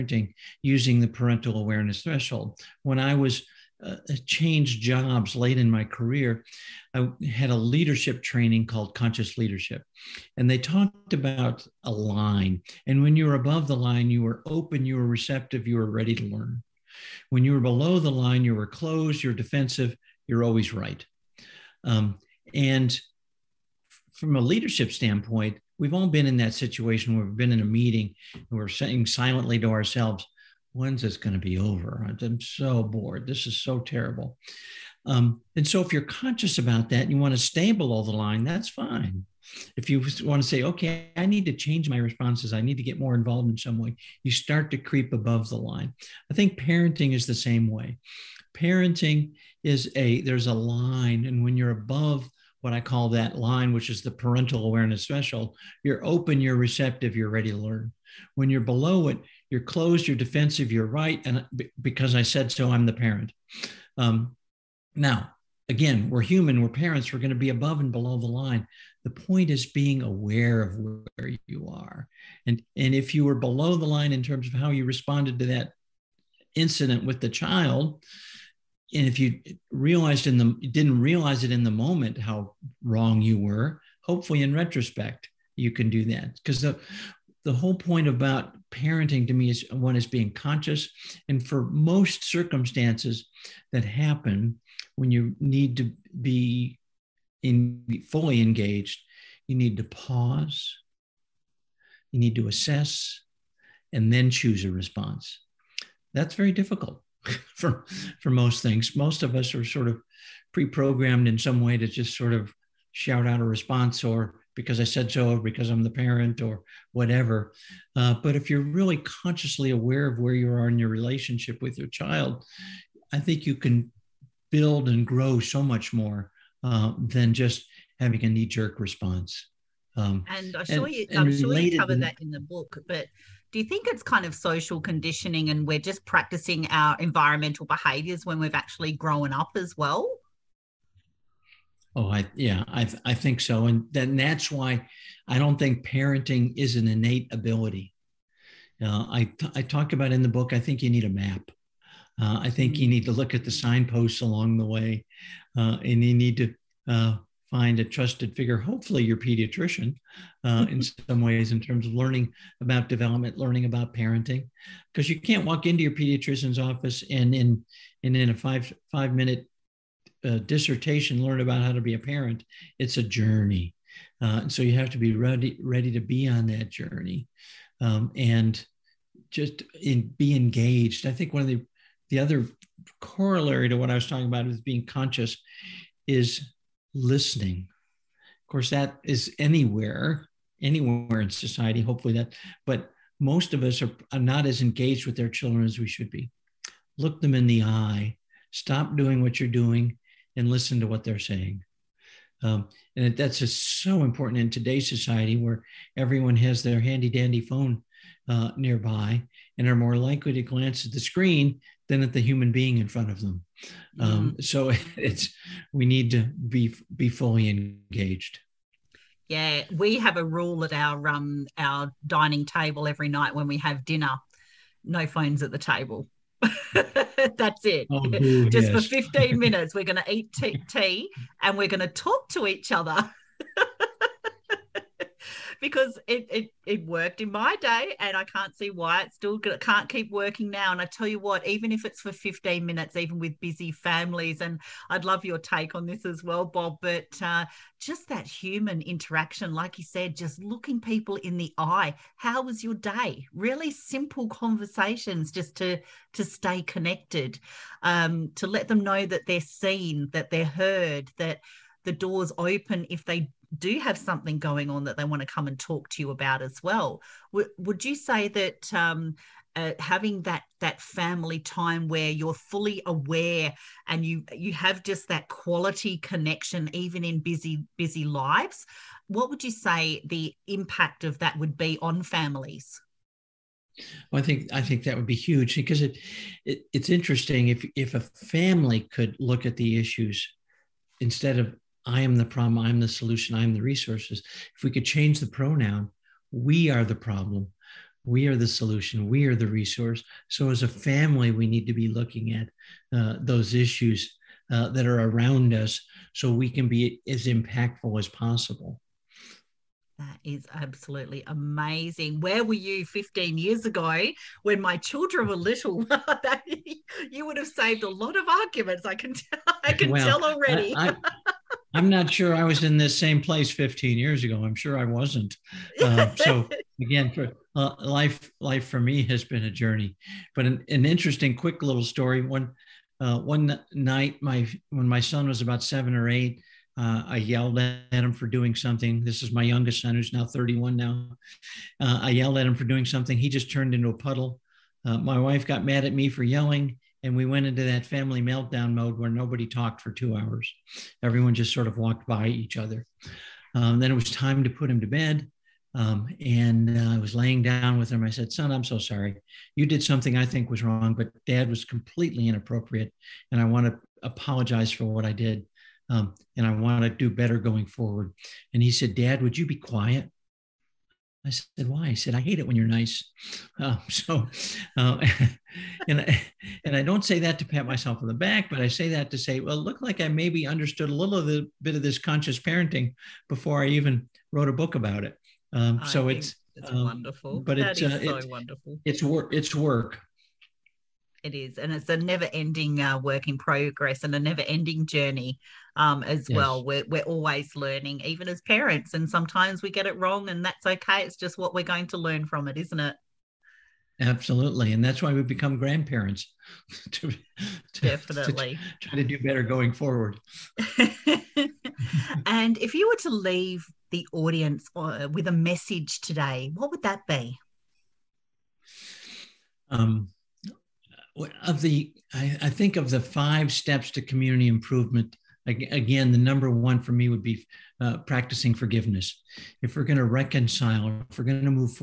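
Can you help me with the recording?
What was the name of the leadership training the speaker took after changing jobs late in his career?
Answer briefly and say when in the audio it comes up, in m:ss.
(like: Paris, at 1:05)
Conscious Leadership, at 0:08.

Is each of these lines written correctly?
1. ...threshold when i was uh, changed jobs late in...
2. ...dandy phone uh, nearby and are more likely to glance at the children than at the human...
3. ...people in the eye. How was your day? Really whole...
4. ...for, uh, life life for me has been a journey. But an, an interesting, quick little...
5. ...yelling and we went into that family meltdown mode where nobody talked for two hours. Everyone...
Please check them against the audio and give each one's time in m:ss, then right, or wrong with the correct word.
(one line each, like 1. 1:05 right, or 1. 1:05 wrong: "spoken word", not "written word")
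1. 0:02 right
2. 3:27 wrong: "screen", not "children"
3. 4:10 wrong: "simple", not "whole"
4. 5:27 right
5. 5:46 right.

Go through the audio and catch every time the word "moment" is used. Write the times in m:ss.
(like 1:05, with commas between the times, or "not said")
1:21.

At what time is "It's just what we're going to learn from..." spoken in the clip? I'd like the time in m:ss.
6:41.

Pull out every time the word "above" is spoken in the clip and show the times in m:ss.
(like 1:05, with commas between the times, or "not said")
0:13, 0:45, 0:51, 1:07.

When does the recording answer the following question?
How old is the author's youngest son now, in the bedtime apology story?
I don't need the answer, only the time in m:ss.
5:40.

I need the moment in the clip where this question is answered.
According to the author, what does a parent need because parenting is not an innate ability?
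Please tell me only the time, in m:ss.
2:31.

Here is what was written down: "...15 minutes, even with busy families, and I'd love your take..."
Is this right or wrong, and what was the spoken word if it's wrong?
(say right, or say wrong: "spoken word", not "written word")
right.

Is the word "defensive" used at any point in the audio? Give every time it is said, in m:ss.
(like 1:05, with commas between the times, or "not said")
0:19, 1:00.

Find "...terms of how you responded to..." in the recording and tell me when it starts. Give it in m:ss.
1:14.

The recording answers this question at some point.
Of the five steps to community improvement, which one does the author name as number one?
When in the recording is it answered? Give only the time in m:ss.
7:07.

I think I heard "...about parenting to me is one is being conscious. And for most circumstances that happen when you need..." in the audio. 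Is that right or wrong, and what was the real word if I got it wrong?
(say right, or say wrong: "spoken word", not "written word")
right.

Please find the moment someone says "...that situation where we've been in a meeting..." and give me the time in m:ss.
0:26.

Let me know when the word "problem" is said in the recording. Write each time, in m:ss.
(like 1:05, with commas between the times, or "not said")
4:52, 4:56.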